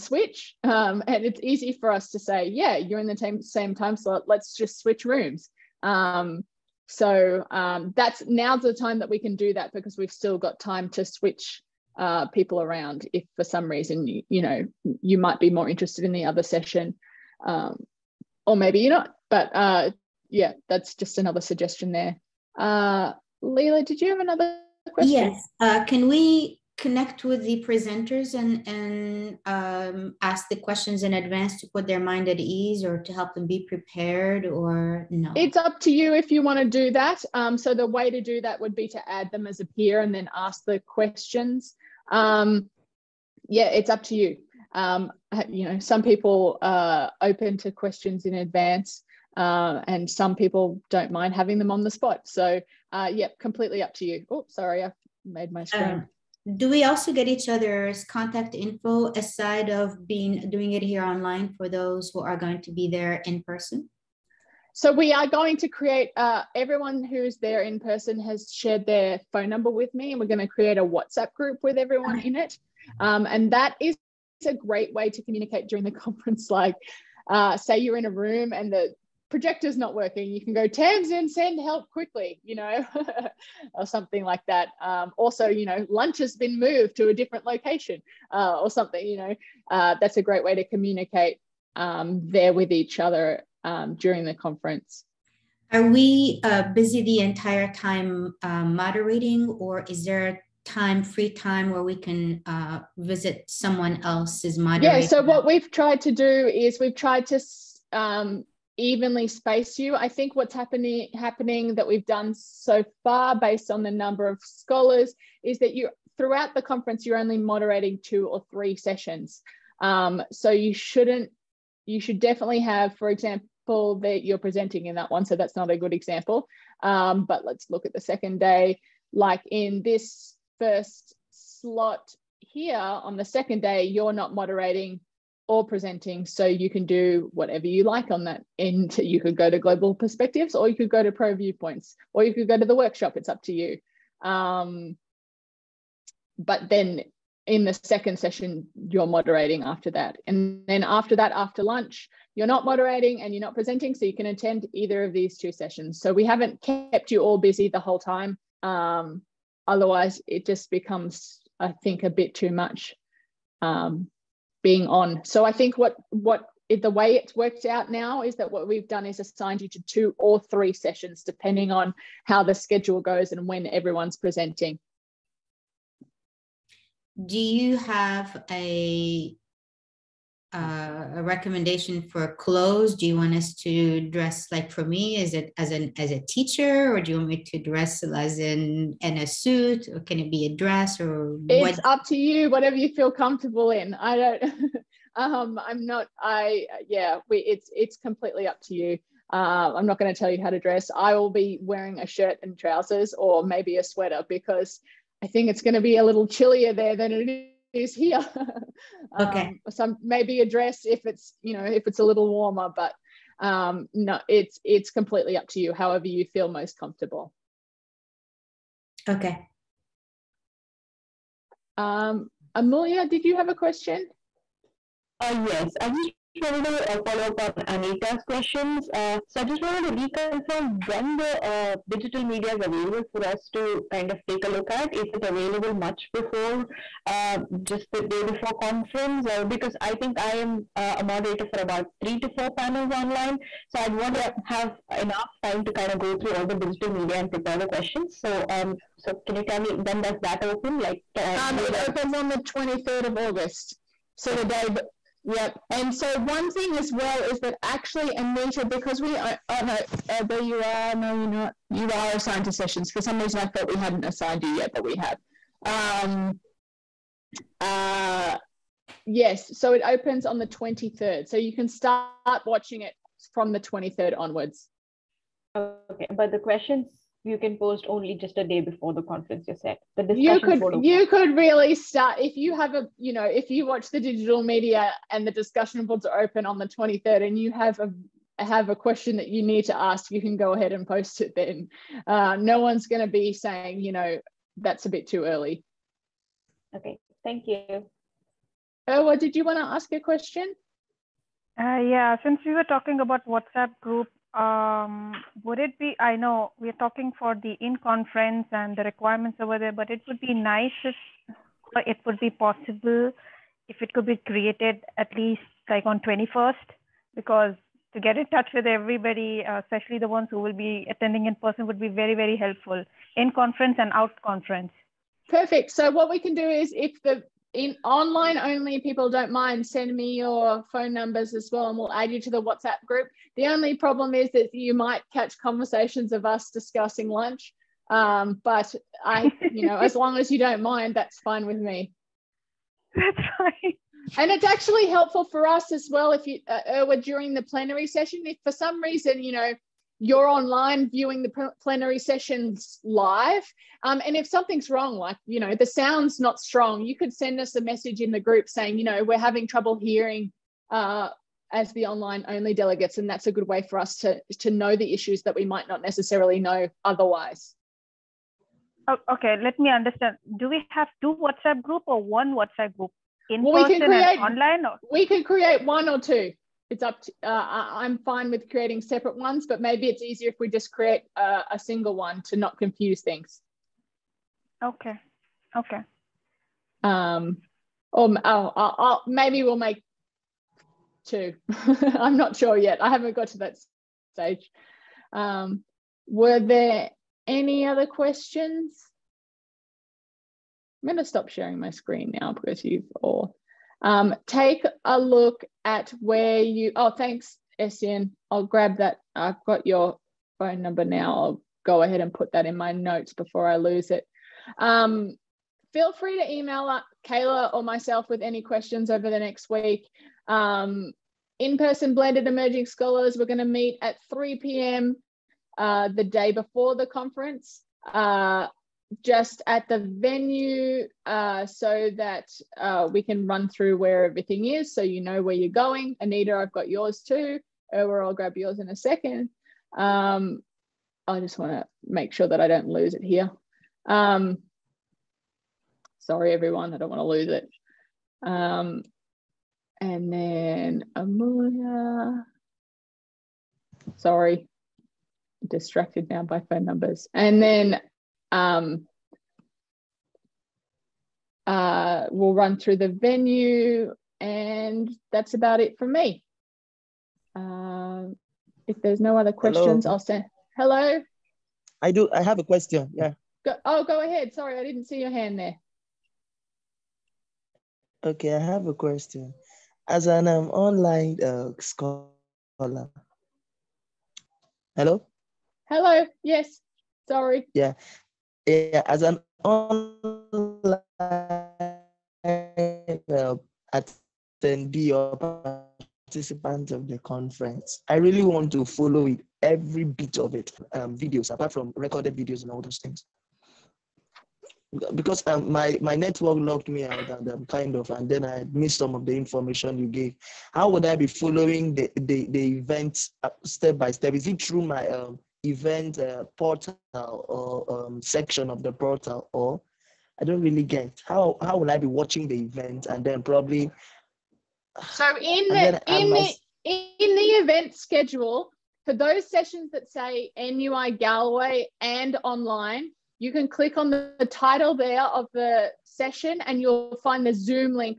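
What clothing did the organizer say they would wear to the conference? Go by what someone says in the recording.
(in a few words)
A shirt and trousers.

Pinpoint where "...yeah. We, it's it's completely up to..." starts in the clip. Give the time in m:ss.
3:16.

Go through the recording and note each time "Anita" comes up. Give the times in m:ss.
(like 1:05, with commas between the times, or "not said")
3:47, 4:18, 7:16.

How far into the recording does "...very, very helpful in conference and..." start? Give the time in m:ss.
5:21.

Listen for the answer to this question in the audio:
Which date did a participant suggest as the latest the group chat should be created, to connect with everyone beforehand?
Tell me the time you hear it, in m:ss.
5:16.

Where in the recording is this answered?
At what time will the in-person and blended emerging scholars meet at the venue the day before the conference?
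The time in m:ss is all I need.
7:04.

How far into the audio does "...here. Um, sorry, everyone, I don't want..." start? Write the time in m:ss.
7:23.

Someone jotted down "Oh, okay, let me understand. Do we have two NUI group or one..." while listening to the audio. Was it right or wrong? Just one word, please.
wrong.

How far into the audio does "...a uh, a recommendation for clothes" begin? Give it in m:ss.
2:58.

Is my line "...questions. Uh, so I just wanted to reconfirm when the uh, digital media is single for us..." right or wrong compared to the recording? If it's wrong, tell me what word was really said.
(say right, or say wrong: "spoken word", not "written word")
wrong: "available", not "single".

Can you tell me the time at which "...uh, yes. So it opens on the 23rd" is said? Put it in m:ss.
4:27.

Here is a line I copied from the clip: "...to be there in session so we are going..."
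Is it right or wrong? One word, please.
wrong.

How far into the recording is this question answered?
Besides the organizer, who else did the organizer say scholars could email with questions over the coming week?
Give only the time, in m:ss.
6:57.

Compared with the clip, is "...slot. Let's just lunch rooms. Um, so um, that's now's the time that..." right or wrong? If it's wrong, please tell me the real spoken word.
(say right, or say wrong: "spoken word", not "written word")
wrong: "switch", not "lunch".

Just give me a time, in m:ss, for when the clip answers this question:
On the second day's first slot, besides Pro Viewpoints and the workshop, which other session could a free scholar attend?
2:19.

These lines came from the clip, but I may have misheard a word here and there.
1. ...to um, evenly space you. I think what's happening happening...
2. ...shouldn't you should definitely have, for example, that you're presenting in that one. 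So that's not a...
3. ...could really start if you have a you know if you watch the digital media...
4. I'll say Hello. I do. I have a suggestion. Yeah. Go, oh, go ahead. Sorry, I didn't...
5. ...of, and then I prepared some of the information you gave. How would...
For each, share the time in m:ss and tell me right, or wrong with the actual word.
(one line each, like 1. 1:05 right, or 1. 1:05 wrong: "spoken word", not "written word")
1. 1:47 right
2. 2:00 right
3. 4:41 right
4. 7:49 wrong: "question", not "suggestion"
5. 8:27 wrong: "missed", not "prepared".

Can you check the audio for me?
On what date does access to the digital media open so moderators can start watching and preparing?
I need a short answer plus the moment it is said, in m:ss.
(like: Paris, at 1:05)
23 August, at 4:12.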